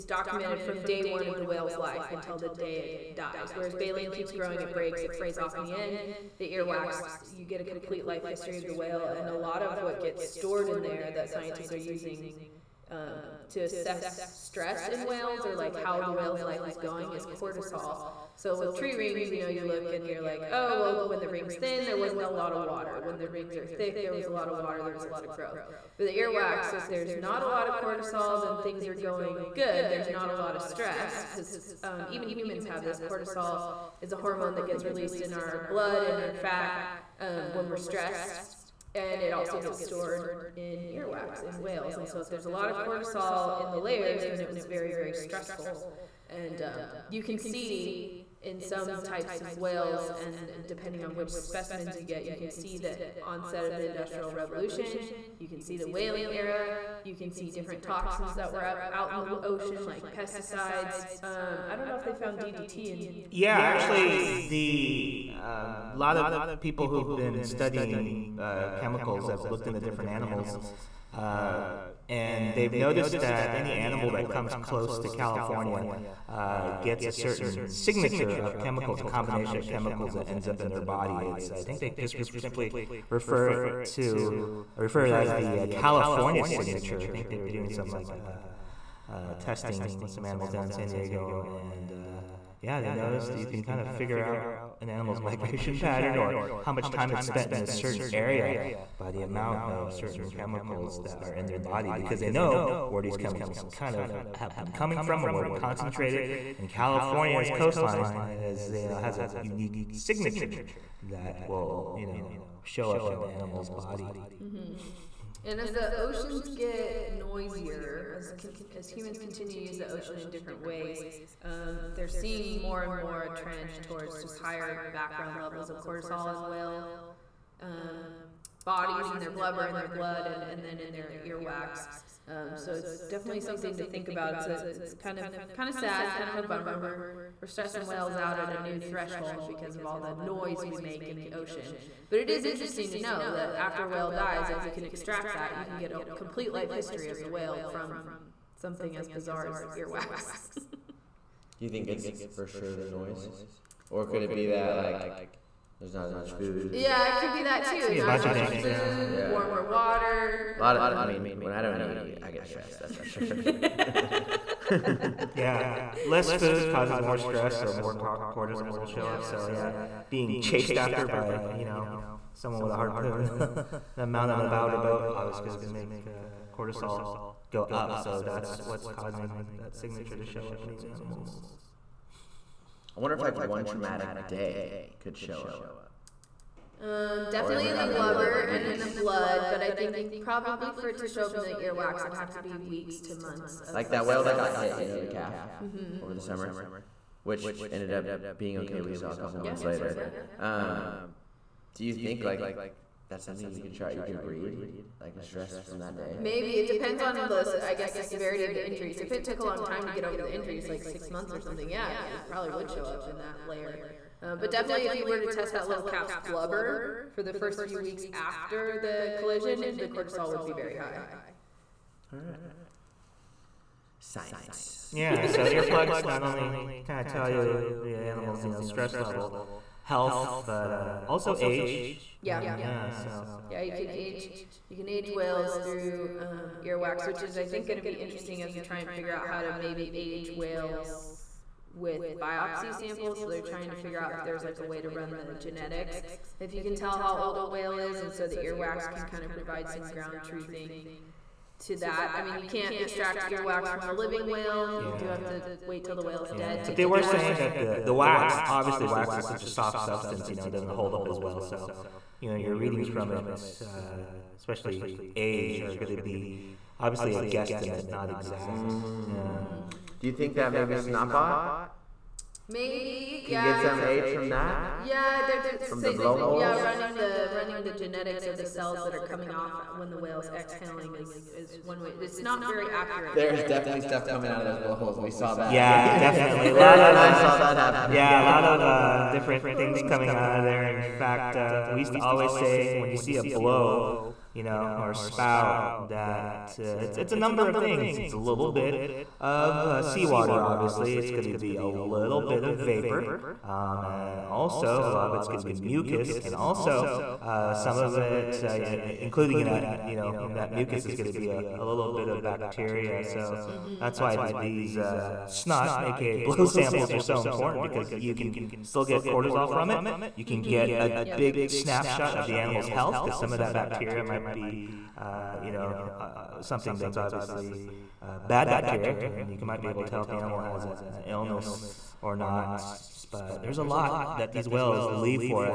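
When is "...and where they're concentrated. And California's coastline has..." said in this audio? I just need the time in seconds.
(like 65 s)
105 s.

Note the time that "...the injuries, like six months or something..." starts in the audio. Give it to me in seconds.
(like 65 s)
210 s.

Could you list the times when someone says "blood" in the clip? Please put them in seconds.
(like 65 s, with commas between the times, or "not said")
35 s, 129 s, 188 s.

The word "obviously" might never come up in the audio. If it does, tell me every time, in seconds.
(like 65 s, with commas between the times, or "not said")
175 s, 258 s, 266 s, 300 s, 326 s.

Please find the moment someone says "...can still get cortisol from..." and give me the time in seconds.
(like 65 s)
318 s.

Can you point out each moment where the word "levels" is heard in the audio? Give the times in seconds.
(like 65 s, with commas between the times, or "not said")
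125 s, 228 s.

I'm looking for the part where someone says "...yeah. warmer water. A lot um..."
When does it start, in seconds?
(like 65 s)
159 s.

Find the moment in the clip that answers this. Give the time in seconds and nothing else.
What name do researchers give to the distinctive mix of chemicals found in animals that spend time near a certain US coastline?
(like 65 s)
85 s.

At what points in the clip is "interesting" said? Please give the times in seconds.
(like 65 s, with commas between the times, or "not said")
142 s, 237 s.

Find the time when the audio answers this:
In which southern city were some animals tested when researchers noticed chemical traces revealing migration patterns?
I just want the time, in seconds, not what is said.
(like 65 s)
90 s.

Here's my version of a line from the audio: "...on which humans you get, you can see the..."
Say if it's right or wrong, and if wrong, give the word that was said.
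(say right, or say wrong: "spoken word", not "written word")
wrong: "specimens", not "humans".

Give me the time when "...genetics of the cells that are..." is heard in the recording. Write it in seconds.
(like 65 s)
277 s.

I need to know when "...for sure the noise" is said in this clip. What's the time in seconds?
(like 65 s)
152 s.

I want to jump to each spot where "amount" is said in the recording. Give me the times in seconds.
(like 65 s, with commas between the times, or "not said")
99 s, 174 s.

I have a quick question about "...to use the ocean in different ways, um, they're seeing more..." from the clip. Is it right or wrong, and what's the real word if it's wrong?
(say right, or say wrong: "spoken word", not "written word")
right.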